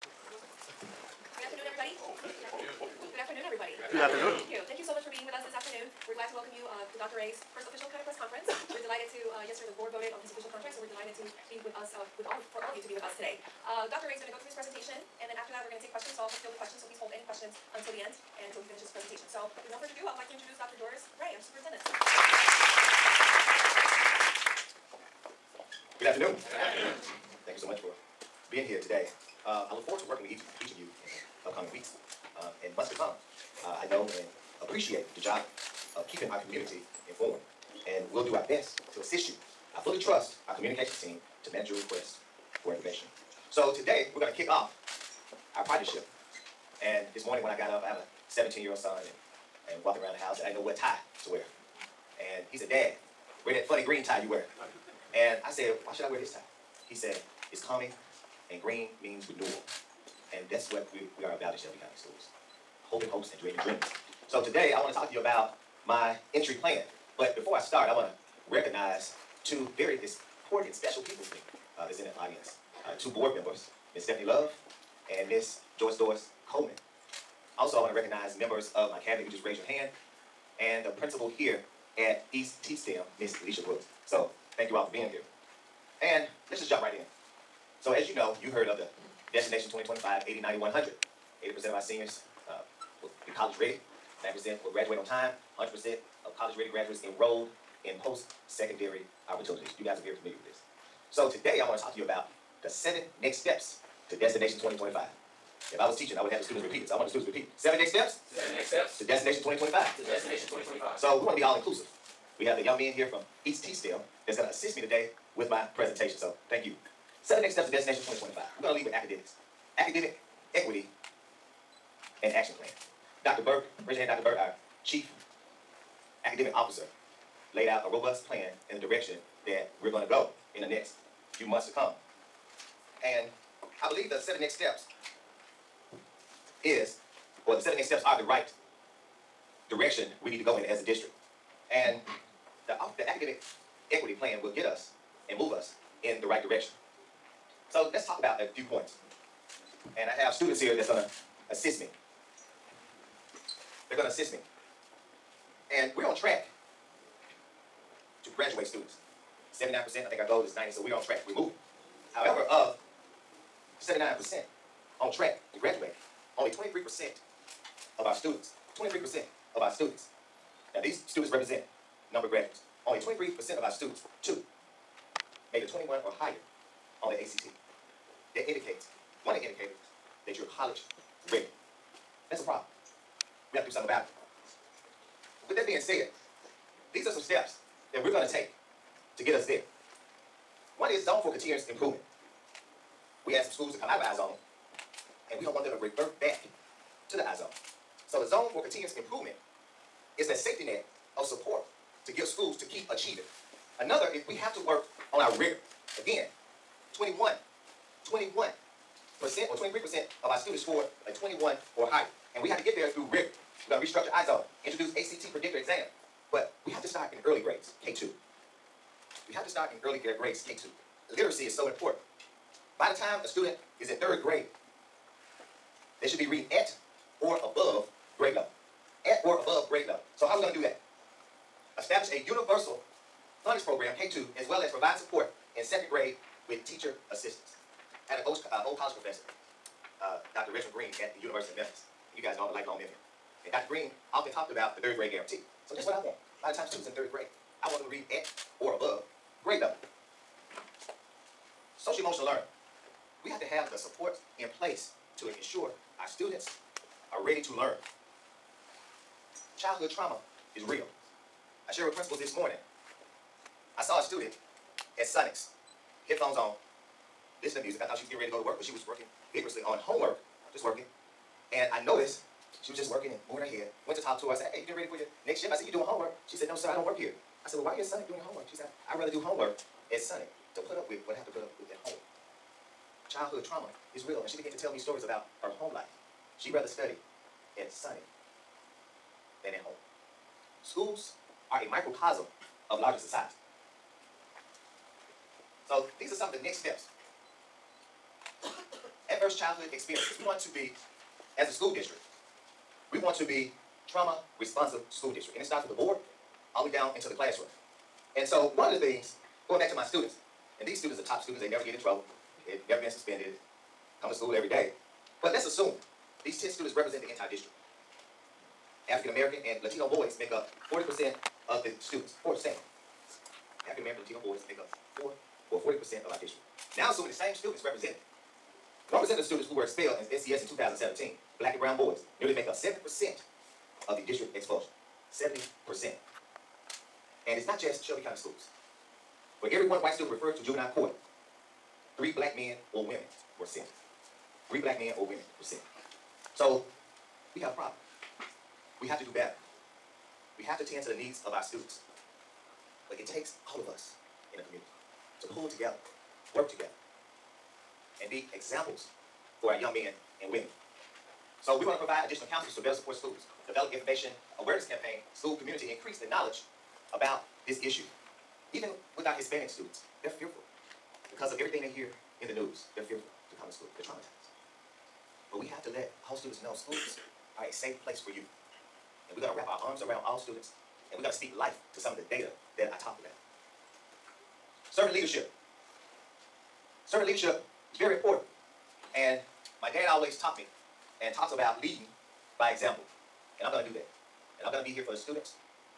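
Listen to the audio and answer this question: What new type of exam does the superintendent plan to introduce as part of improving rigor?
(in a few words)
ACT predictor exam.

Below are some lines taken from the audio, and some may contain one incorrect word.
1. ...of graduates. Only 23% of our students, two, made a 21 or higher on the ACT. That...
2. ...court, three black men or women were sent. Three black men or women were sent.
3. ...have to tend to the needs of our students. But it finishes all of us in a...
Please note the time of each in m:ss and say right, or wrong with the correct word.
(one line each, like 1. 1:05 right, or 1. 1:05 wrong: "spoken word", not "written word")
1. 2:52 right
2. 5:40 right
3. 5:50 wrong: "takes", not "finishes".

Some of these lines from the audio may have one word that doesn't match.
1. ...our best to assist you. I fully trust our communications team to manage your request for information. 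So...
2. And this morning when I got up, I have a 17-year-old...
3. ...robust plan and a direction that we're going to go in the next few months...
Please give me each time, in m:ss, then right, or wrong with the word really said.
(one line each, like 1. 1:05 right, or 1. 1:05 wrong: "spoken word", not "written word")
1. 0:38 right
2. 0:46 right
3. 2:07 right.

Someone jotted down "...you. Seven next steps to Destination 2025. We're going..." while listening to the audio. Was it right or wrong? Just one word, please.
right.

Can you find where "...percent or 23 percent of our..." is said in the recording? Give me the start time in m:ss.
3:29.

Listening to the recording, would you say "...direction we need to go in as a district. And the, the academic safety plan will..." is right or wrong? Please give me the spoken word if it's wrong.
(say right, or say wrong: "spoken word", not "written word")
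wrong: "equity", not "safety".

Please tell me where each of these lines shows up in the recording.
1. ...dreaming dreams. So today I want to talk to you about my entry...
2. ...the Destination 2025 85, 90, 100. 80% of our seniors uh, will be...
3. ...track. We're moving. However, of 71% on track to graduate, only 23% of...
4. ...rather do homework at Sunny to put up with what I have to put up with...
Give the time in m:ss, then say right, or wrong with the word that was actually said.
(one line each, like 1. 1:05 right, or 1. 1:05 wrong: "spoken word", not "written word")
1. 1:03 right
2. 1:28 wrong: "80", not "85"
3. 2:41 wrong: "79", not "71"
4. 4:38 wrong: "Sonic", not "Sunny".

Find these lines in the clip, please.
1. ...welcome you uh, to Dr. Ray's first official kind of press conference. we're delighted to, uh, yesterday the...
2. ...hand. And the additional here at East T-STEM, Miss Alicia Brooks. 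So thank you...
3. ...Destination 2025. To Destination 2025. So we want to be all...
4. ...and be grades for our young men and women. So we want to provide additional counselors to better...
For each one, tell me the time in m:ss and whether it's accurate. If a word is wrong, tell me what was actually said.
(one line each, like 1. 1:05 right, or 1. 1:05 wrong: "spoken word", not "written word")
1. 0:06 right
2. 1:19 wrong: "principal", not "additional"
3. 1:49 right
4. 5:58 wrong: "examples", not "grades".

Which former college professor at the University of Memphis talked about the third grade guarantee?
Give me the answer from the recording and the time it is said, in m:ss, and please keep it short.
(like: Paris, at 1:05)
Dr. Richmond Green, at 4:00.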